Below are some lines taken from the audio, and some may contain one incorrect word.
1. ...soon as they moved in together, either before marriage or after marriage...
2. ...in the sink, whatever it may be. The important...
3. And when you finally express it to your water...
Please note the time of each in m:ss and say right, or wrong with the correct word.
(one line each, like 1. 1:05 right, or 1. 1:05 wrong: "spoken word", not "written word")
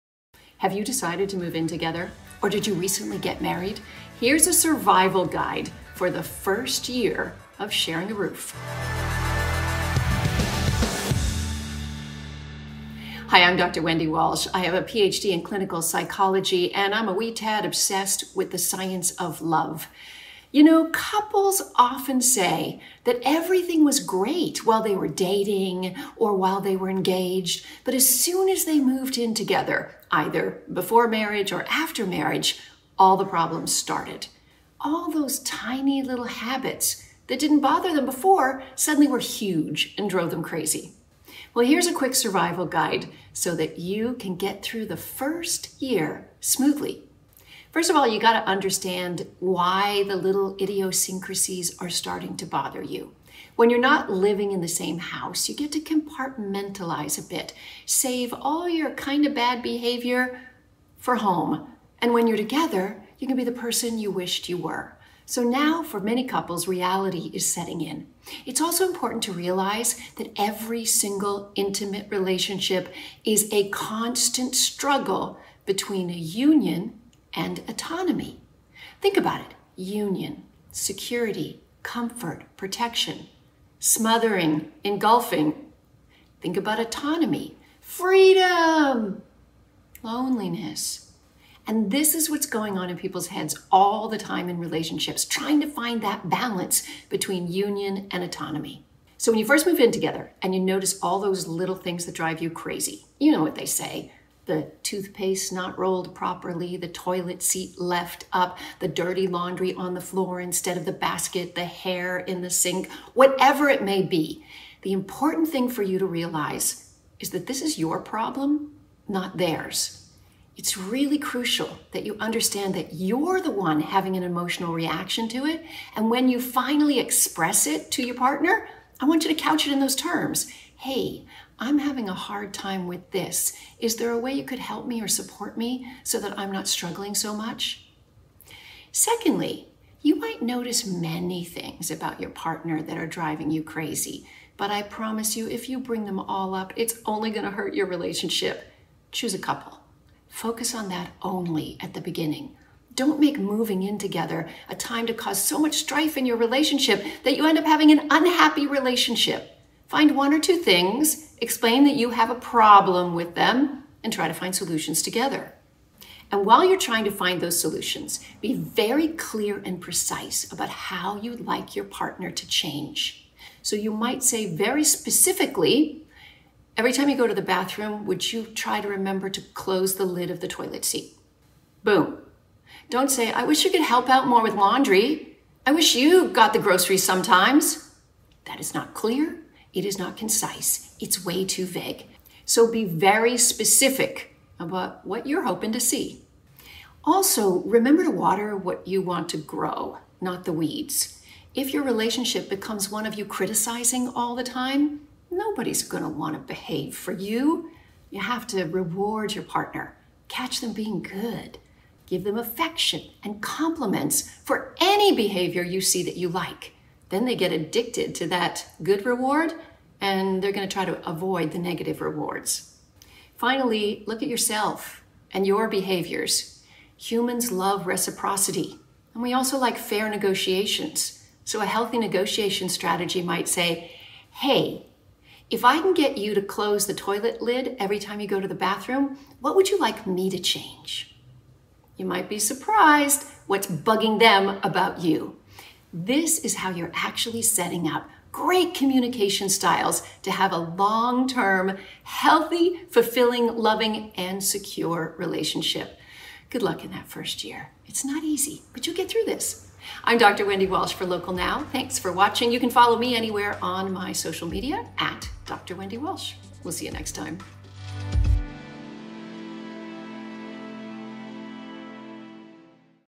1. 0:28 right
2. 1:52 right
3. 2:05 wrong: "partner", not "water".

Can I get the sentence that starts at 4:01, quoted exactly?
You might be surprised what's bugging them about you.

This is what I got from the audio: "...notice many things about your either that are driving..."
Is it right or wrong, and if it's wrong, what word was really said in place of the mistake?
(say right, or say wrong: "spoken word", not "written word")
wrong: "partner", not "either".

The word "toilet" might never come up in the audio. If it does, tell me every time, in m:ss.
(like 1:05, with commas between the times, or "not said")
1:46, 3:00, 3:56.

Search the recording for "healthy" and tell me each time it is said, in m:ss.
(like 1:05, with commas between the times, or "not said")
3:51, 4:12.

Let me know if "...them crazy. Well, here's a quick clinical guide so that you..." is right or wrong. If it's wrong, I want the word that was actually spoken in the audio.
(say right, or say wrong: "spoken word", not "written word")
wrong: "survival", not "clinical".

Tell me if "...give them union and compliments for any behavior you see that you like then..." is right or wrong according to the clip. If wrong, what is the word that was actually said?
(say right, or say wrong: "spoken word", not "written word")
wrong: "affection", not "union".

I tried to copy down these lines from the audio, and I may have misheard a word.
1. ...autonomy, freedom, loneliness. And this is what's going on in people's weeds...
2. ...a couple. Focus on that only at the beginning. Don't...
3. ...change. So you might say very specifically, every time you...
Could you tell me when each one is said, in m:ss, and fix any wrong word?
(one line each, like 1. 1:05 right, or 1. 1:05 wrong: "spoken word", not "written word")
1. 1:26 wrong: "heads", not "weeds"
2. 2:29 right
3. 2:52 right.